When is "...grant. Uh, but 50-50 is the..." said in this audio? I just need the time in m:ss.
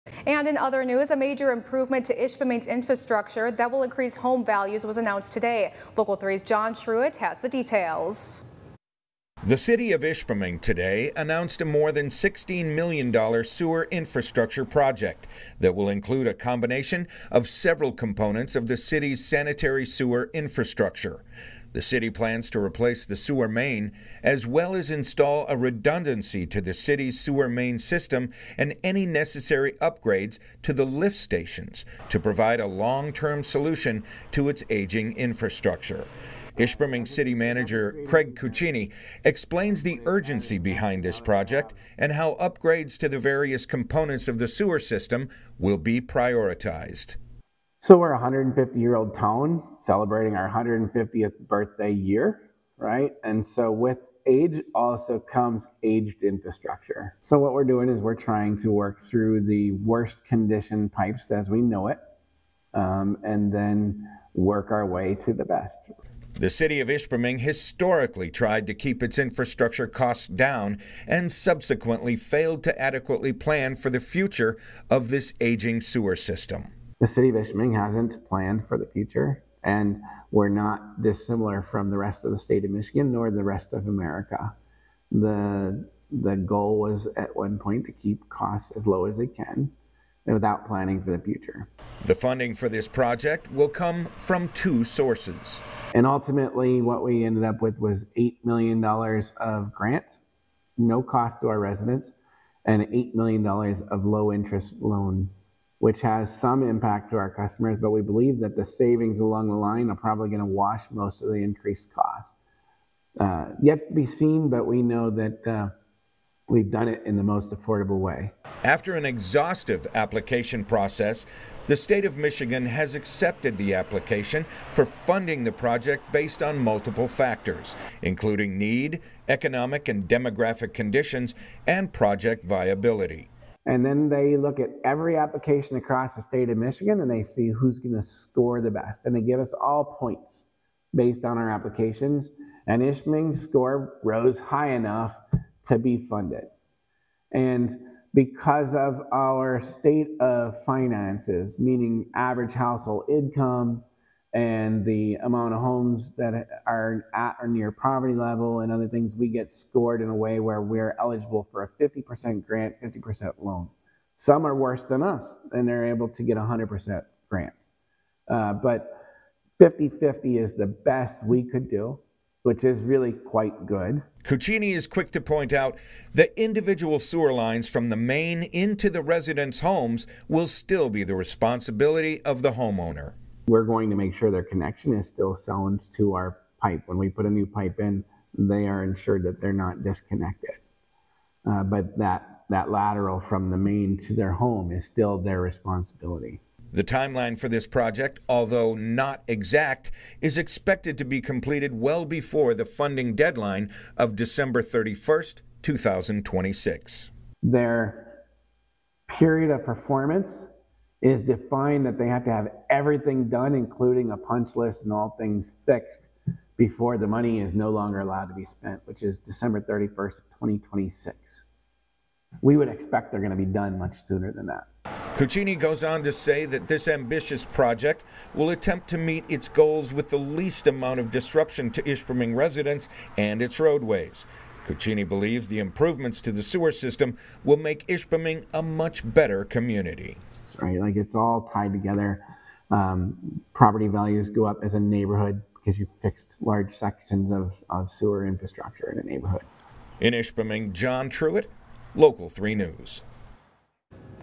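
2:47.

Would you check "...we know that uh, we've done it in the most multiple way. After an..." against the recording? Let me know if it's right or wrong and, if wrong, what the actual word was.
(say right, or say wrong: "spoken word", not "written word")
wrong: "affordable", not "multiple".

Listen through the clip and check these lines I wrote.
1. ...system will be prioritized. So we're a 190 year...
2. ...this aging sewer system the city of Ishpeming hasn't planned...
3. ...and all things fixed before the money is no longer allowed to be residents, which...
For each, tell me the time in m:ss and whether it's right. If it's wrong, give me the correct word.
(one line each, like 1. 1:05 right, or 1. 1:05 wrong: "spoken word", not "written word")
1. 0:44 wrong: "150", not "190"
2. 1:15 right
3. 3:34 wrong: "spent", not "residents".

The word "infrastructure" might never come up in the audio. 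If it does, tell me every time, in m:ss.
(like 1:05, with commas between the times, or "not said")
0:02, 0:13, 0:20, 0:35, 0:56, 1:09, 4:08.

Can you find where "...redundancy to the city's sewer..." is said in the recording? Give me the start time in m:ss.
0:25.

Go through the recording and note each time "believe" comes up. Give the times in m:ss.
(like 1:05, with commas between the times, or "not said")
1:48, 3:55.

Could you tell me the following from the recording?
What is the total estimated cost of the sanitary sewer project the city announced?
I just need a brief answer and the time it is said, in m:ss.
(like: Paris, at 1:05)
more than $16 million, at 0:11.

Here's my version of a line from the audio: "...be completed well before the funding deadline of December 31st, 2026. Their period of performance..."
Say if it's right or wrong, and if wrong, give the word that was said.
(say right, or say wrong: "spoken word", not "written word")
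right.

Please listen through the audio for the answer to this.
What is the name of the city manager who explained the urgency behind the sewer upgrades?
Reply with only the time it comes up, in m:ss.
0:38.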